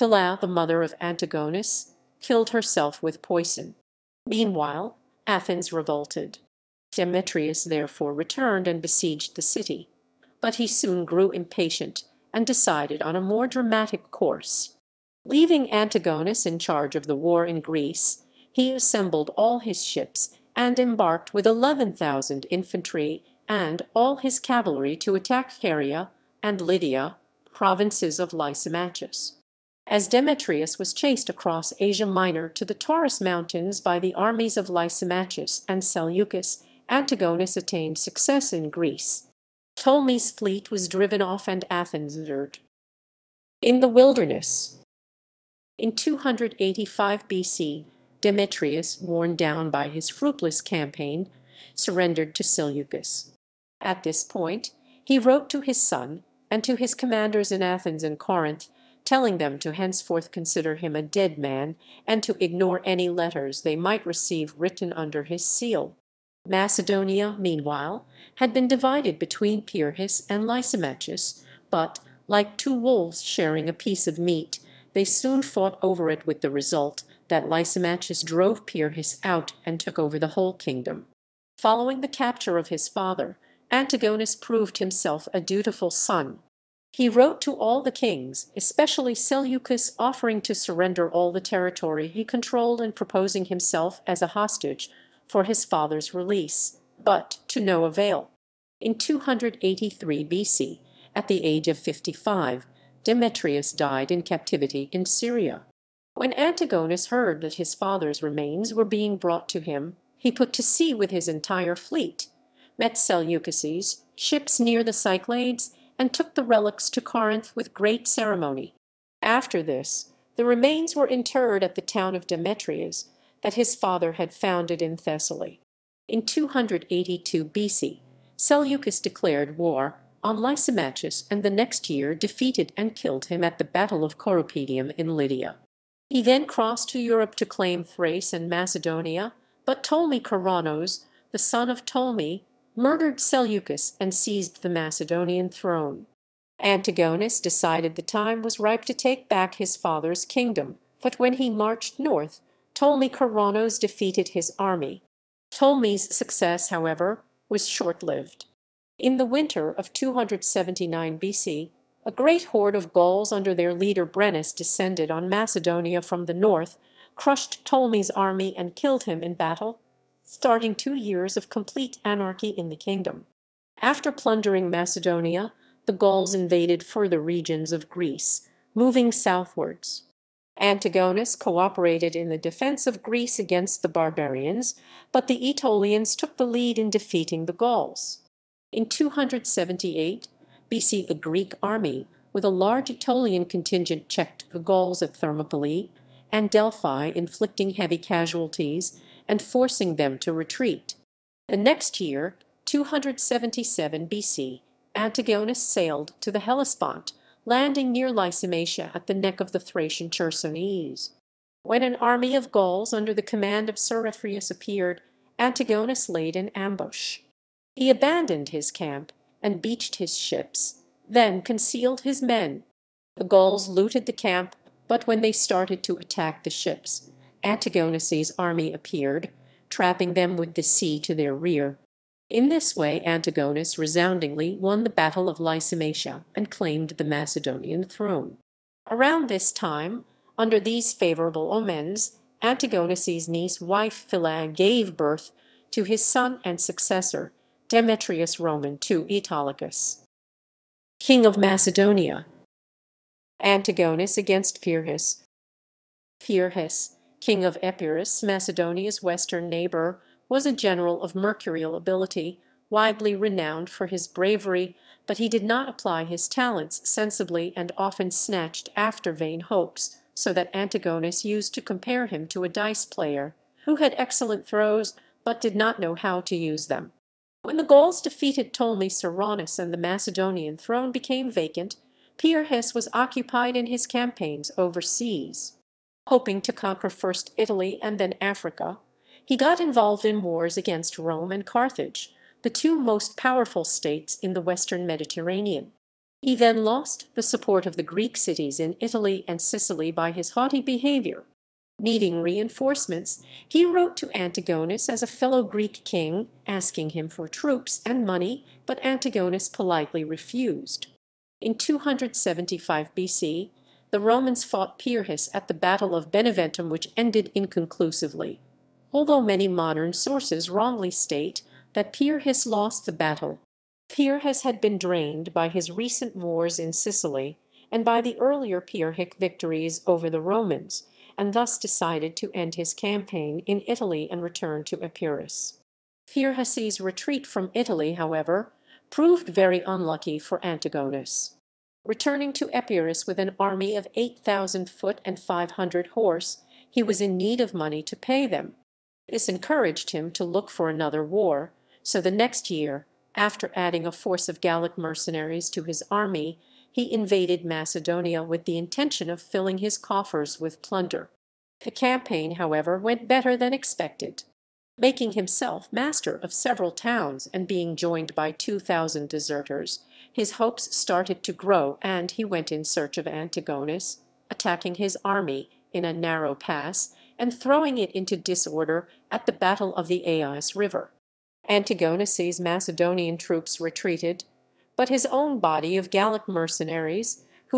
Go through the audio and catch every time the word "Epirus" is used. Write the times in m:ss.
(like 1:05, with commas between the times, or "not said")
4:17, 5:34, 5:42.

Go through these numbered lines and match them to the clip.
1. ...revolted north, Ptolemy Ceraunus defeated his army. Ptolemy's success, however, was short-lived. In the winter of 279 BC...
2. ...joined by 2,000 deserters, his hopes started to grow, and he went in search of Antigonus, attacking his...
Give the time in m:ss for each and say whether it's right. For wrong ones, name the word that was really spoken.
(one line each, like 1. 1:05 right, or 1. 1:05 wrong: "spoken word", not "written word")
1. 2:31 wrong: "marched", not "revolted"
2. 6:07 right.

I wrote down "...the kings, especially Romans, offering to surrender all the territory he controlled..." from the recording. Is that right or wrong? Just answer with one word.
wrong.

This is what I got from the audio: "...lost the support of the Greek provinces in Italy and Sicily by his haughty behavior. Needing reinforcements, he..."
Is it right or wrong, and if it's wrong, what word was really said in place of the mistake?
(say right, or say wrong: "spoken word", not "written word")
wrong: "cities", not "provinces".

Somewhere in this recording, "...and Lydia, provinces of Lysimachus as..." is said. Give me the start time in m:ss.
0:26.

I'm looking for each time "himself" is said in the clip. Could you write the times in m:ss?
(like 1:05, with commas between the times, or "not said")
1:24, 1:33, 6:05.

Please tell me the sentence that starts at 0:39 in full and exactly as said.
Ptolemy's fleet was driven off and Athens entered.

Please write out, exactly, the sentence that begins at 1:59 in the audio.
After this, the remains were interred at the town of Demetrius that his father had founded in Thessaly.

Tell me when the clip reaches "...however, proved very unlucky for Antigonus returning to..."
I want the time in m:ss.
5:37.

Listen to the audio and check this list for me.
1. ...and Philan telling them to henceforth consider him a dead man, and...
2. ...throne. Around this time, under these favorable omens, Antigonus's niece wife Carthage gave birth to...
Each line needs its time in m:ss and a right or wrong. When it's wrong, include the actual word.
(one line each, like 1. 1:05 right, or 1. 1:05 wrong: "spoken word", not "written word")
1. 0:58 wrong: "Corinth", not "Philan"
2. 3:57 wrong: "Philan", not "Carthage".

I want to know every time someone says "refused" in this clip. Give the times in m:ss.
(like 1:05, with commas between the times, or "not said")
5:10.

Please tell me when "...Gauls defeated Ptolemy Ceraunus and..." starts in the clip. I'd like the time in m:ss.
4:37.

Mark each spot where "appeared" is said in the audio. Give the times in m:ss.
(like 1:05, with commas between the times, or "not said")
3:34, 3:48.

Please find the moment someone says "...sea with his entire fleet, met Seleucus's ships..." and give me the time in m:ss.
1:50.